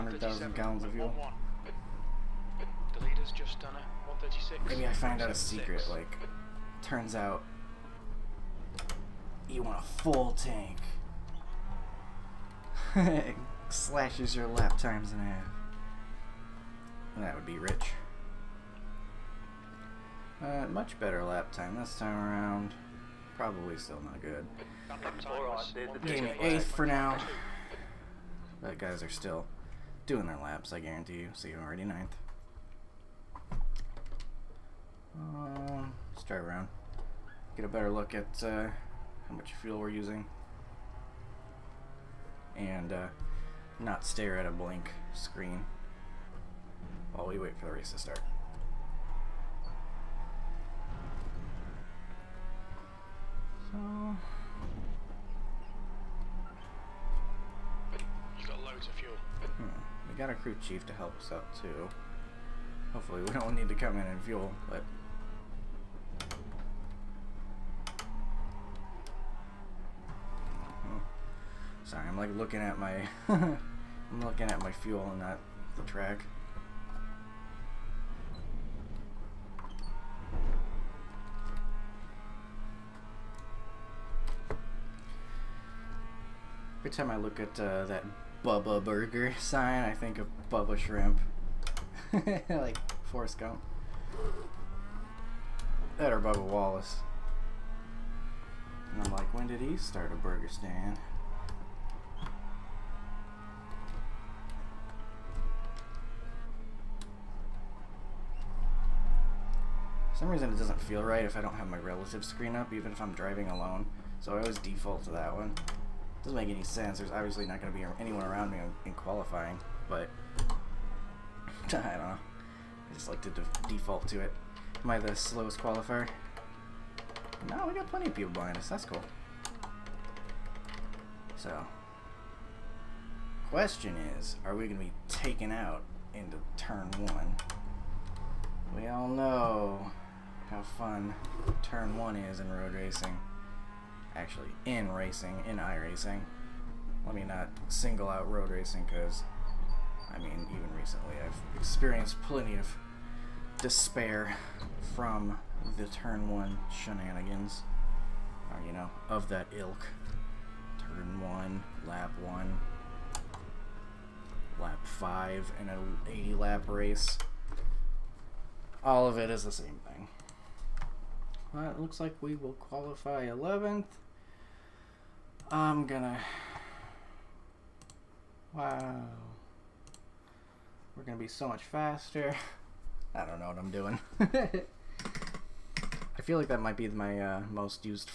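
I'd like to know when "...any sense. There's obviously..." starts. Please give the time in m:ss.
1:56.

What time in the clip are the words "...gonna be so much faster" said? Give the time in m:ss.
3:01.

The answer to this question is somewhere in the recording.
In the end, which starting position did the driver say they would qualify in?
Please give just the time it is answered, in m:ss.
2:53.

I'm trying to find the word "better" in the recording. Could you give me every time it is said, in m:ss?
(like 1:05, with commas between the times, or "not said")
0:20, 0:37.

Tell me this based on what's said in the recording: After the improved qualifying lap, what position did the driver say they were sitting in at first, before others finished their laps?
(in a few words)
8th.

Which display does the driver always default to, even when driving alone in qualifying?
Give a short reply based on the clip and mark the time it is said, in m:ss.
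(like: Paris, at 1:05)
relative screen, at 1:51.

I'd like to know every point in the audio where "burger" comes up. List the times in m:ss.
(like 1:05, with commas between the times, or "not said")
1:28, 1:40.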